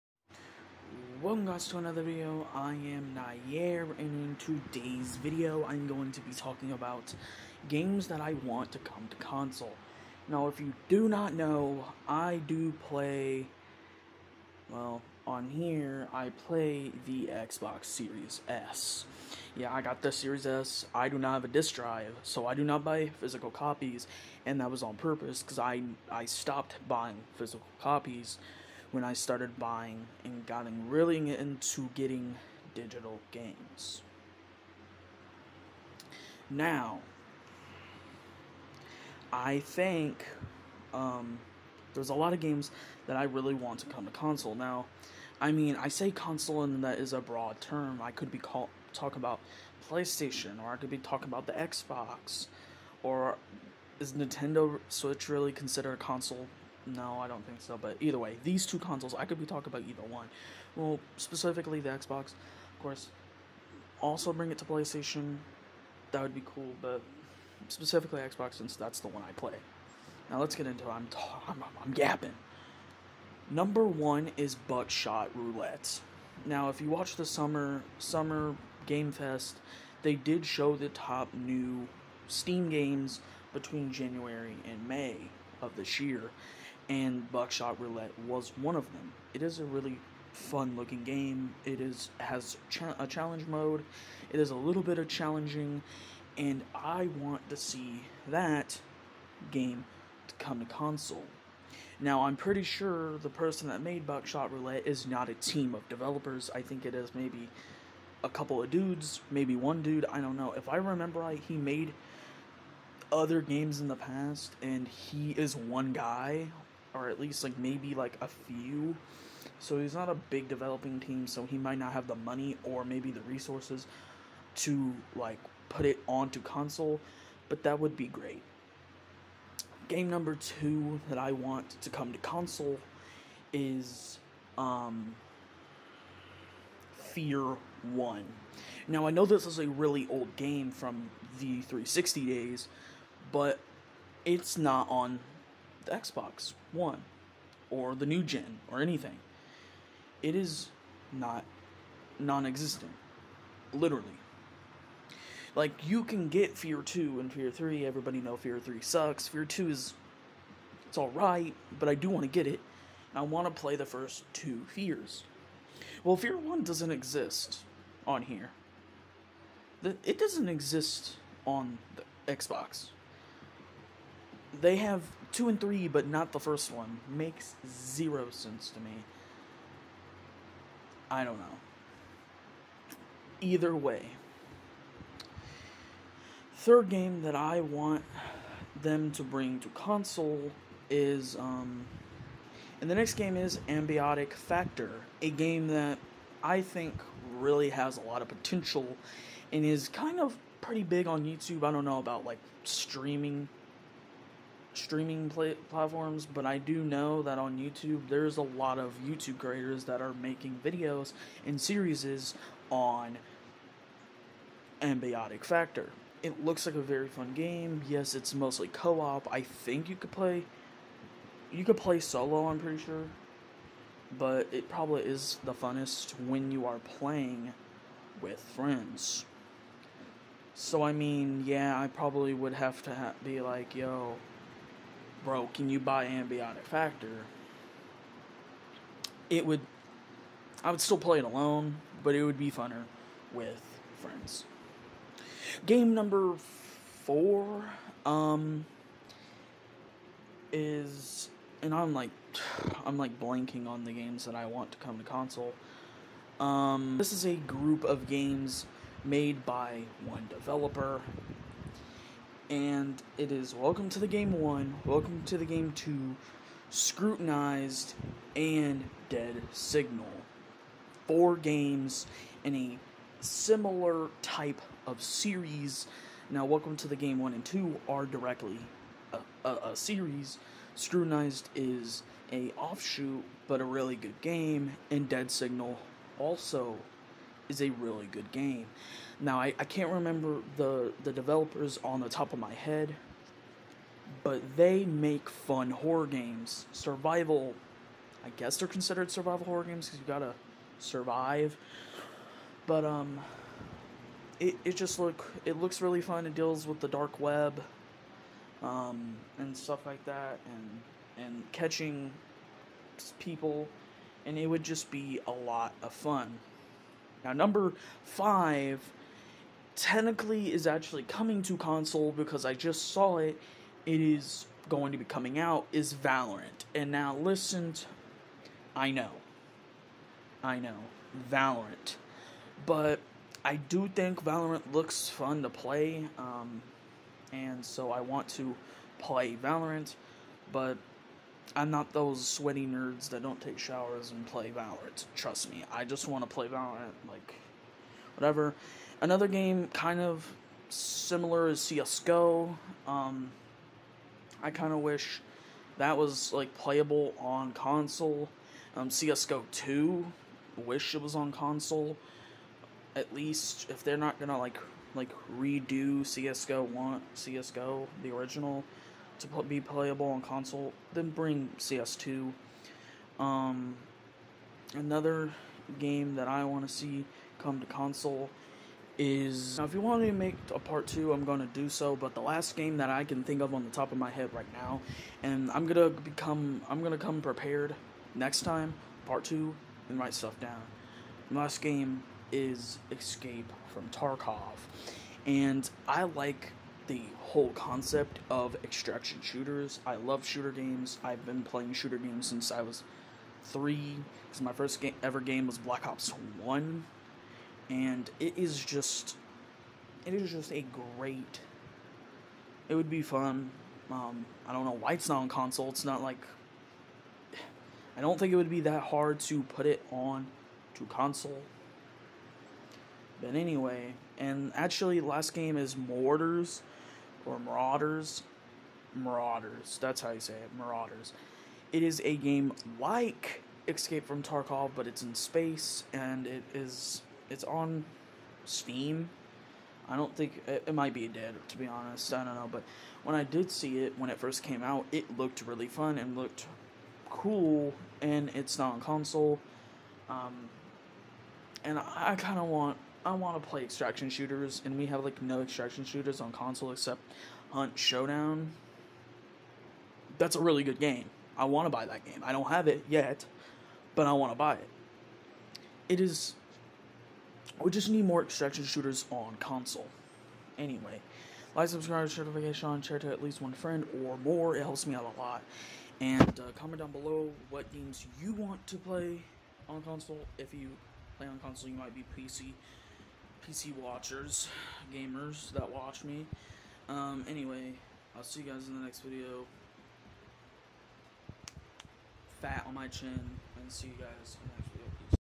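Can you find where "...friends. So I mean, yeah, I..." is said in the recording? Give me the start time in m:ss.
3:48.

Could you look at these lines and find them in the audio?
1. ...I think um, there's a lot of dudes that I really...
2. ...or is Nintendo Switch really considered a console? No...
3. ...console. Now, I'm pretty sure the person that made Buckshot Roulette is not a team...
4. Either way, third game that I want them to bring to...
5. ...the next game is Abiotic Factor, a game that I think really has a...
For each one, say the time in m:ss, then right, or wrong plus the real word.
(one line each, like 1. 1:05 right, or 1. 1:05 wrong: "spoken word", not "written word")
1. 0:39 wrong: "games", not "dudes"
2. 0:53 right
3. 1:40 right
4. 3:03 right
5. 3:12 right.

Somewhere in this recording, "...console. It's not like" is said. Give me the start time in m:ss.
6:55.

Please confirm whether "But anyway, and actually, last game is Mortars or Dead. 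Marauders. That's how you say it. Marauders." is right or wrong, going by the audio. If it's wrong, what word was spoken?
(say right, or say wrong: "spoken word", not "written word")
wrong: "Marauders", not "Dead".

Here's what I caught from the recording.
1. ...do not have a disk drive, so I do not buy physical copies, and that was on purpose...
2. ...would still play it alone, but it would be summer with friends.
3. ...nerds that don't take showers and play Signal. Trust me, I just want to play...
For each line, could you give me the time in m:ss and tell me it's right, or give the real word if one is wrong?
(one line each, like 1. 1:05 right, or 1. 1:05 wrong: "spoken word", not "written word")
1. 0:21 right
2. 4:00 wrong: "funner", not "summer"
3. 5:42 wrong: "Valorant", not "Signal".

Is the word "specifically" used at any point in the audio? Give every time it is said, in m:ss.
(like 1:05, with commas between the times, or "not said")
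1:01, 1:07.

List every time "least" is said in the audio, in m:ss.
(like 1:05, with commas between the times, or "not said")
1:57, 6:03, 7:53.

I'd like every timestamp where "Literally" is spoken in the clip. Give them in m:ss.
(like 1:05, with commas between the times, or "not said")
2:33.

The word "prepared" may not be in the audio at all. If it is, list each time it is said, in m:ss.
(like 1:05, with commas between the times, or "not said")
6:27.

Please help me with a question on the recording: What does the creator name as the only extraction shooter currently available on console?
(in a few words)
Hunt Showdown.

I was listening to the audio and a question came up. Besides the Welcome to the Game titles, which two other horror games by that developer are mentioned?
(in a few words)
Scrutinized and Dead Signal.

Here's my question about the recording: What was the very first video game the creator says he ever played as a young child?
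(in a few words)
Black Ops 1.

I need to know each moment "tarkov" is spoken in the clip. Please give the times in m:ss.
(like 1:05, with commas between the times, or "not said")
6:33, 7:14.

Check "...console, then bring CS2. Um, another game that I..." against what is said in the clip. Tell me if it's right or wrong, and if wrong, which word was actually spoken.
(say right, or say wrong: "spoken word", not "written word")
right.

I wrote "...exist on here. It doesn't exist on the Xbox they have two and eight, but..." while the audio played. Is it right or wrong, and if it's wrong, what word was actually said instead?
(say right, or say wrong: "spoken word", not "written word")
wrong: "three", not "eight".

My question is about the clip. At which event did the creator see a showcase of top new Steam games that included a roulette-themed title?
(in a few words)
Summer Game Fest.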